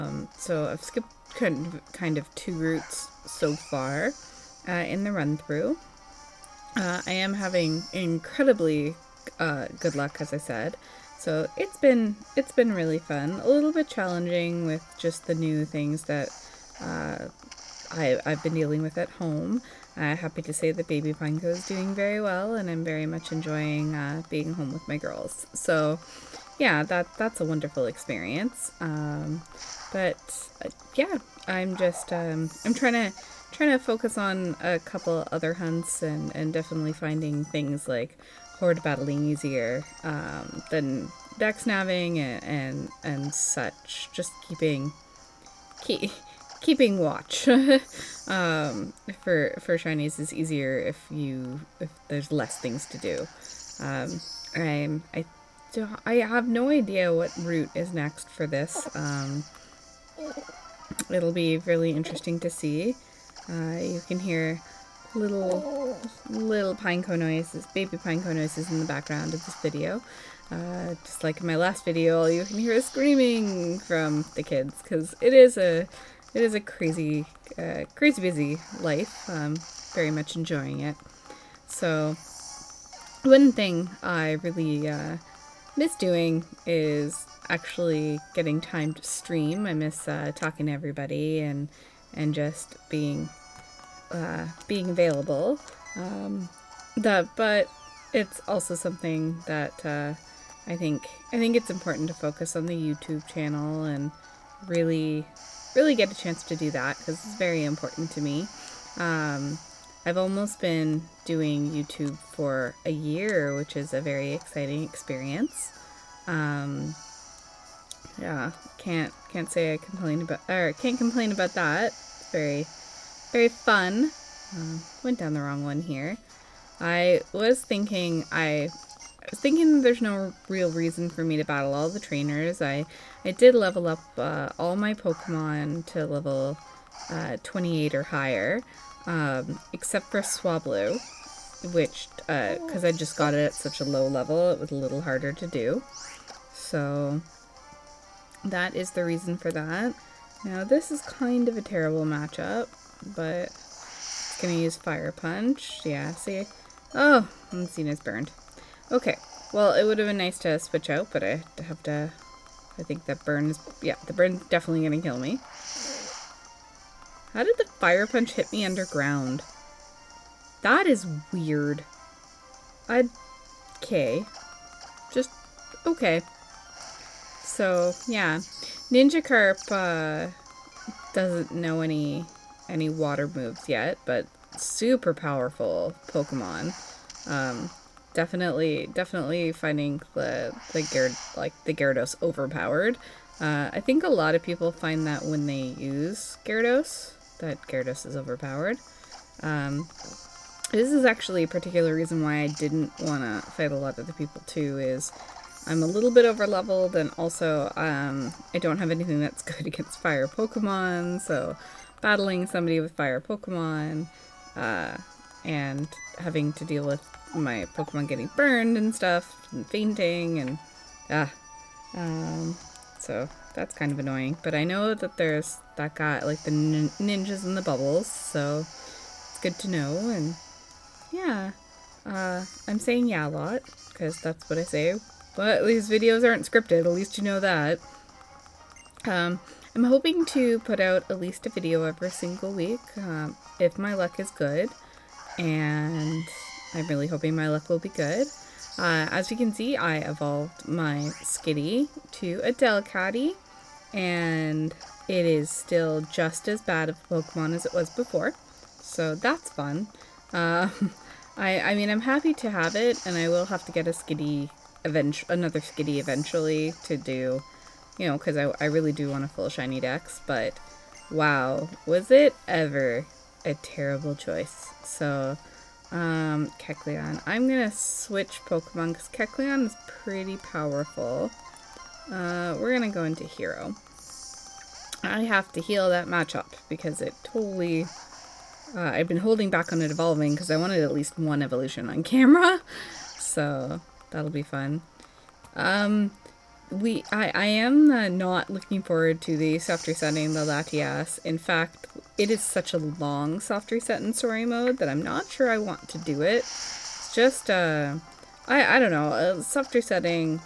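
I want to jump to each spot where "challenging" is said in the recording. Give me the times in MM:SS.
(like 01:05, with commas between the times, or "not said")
00:13.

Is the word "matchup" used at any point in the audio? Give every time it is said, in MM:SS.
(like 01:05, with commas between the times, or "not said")
02:32, 04:46.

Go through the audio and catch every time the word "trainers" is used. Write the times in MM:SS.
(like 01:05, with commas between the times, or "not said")
02:11.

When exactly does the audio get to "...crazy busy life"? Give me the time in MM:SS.
01:17.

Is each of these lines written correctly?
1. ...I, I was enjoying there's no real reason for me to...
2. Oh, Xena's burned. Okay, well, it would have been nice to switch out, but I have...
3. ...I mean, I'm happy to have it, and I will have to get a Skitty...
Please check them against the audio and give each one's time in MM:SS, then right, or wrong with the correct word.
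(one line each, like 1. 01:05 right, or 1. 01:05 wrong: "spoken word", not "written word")
1. 02:08 wrong: "thinking", not "enjoying"
2. 02:36 right
3. 04:21 right.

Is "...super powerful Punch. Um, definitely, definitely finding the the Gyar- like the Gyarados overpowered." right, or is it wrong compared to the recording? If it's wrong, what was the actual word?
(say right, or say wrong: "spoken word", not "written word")
wrong: "Pokemon", not "Punch".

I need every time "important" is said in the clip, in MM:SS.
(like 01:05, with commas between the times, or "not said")
01:41, 01:47.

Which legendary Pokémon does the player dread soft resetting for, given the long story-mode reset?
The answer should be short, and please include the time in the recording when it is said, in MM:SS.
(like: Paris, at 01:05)
Latias, at 05:00.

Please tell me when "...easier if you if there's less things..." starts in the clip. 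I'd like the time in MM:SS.
00:50.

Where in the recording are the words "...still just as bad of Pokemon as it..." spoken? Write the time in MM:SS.
04:15.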